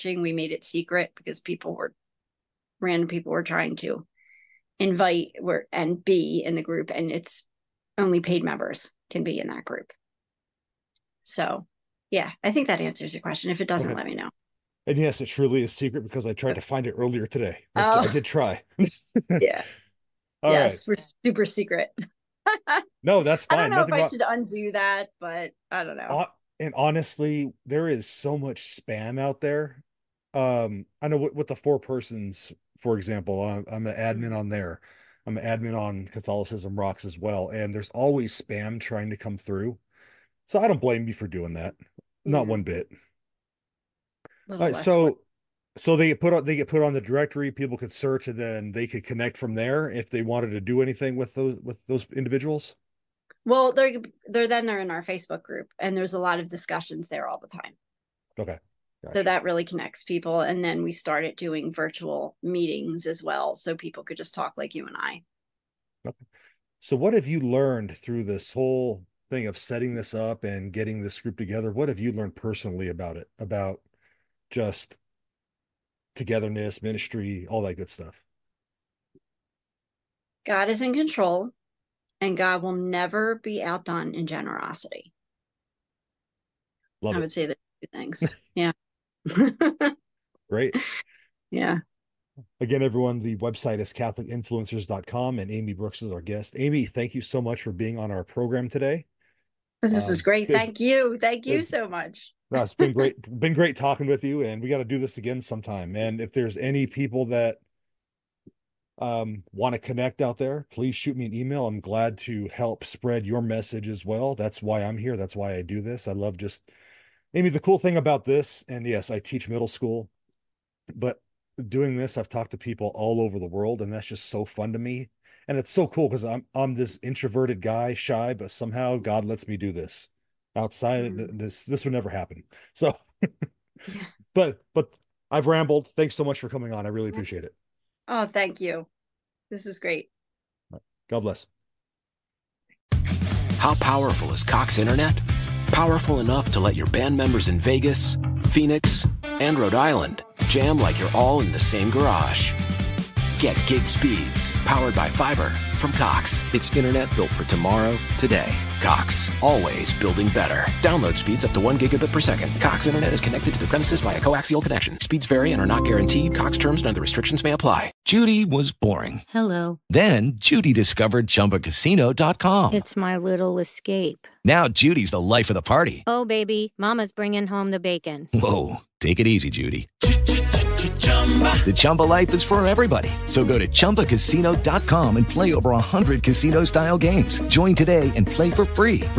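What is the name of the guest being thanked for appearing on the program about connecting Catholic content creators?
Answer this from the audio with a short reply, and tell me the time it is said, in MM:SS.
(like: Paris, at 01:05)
Amy Brooks, at 01:35.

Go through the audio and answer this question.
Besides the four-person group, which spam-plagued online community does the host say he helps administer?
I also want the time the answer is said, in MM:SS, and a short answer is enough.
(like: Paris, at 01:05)
Catholicism Rocks, at 00:36.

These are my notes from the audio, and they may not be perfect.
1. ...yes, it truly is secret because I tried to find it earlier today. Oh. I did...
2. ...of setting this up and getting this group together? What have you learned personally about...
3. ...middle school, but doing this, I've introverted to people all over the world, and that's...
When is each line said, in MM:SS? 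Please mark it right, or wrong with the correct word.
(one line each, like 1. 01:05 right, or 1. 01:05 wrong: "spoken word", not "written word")
1. 00:14 right
2. 01:09 right
3. 01:59 wrong: "talked", not "introverted".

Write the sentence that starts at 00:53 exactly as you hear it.
Well, they're they're then they're in our Facebook group, and there's a lot of discussions there all the time.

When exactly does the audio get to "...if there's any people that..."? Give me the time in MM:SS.
01:46.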